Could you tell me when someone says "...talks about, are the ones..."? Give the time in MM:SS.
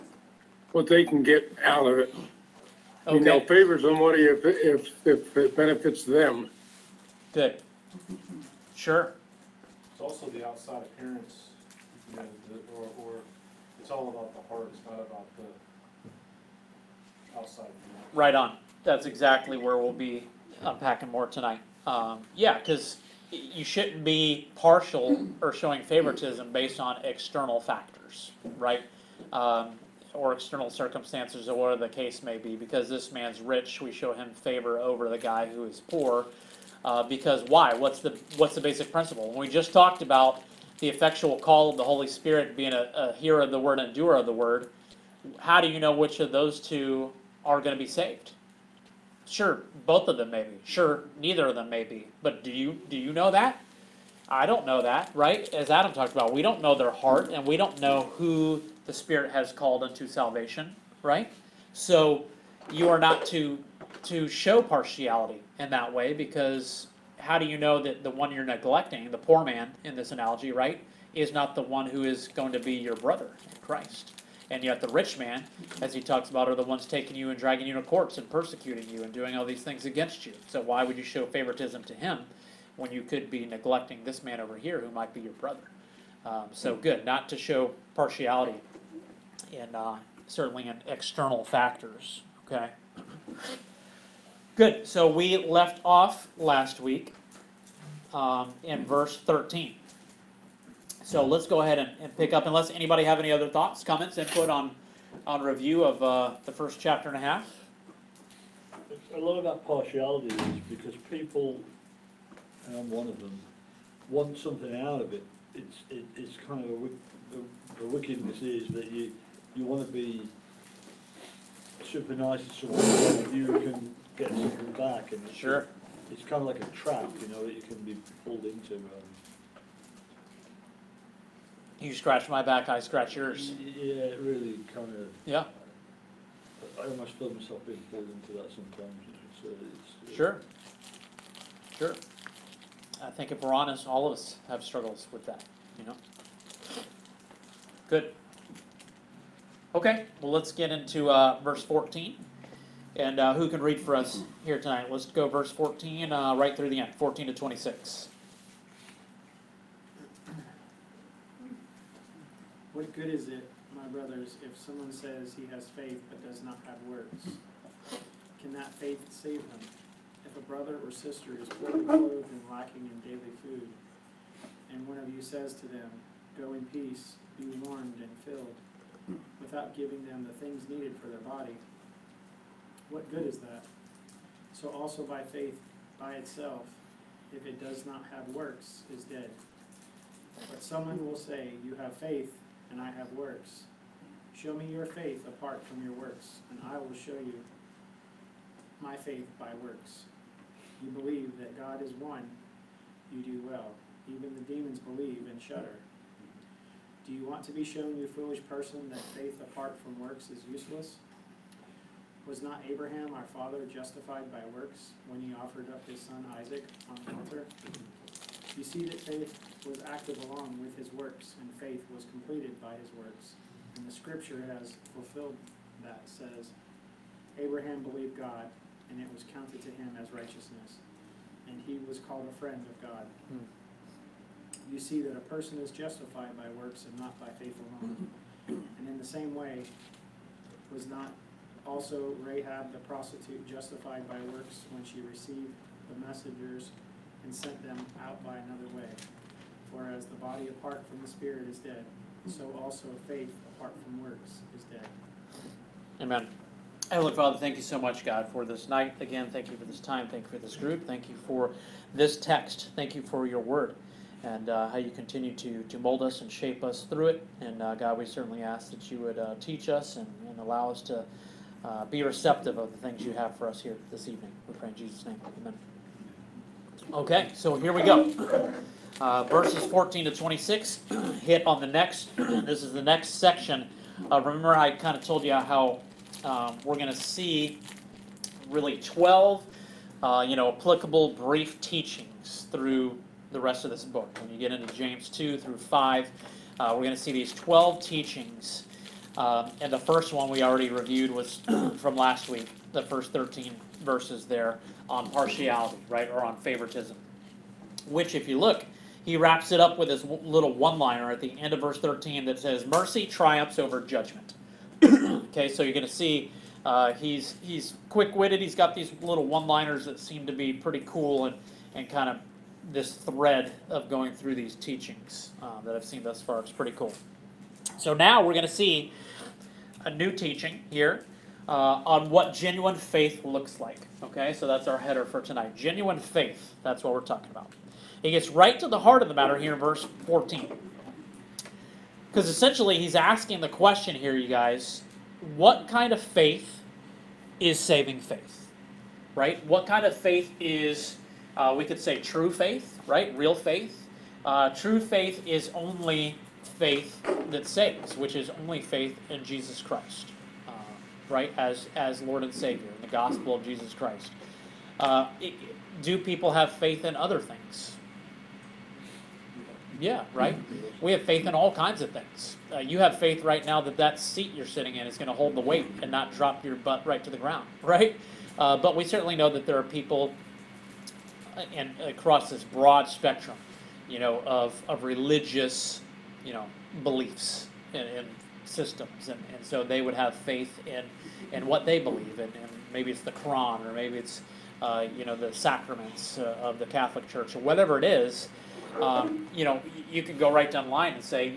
01:16.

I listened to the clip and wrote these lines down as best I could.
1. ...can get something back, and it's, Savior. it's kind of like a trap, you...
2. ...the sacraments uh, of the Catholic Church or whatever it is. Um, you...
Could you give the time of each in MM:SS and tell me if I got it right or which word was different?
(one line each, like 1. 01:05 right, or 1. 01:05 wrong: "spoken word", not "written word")
1. 02:03 wrong: "Sure", not "Savior"
2. 06:35 right.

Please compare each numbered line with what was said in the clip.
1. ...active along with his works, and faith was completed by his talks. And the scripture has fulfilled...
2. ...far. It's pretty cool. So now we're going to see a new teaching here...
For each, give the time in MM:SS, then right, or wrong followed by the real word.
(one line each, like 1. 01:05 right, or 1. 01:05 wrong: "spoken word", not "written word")
1. 03:39 wrong: "works", not "talks"
2. 05:26 right.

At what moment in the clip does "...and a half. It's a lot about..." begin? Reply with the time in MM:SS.
01:47.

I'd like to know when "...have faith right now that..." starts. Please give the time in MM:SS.
06:12.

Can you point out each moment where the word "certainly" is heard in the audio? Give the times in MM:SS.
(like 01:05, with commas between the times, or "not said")
01:30, 04:28, 06:18.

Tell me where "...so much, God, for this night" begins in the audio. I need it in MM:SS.
04:17.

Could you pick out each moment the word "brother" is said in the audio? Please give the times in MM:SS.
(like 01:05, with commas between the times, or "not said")
01:12, 01:25, 02:43, 02:50.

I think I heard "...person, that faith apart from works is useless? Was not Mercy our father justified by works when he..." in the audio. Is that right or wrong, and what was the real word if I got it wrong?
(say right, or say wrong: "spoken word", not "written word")
wrong: "Abraham", not "Mercy".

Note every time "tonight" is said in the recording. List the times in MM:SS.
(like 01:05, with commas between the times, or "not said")
00:21, 02:34, 05:35.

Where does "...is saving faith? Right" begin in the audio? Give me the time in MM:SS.
05:47.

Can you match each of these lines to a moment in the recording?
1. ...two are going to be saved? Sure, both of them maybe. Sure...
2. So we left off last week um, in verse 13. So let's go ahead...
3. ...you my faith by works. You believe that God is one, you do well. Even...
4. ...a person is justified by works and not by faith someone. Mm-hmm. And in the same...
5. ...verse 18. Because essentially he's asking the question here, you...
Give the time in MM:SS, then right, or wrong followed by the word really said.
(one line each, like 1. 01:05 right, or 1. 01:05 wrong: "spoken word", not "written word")
1. 00:46 right
2. 01:34 right
3. 03:17 right
4. 03:55 wrong: "alone", not "someone"
5. 05:39 wrong: "14", not "18".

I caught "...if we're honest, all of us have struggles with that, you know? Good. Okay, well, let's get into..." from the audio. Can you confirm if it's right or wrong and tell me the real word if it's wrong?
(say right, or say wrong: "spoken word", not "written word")
right.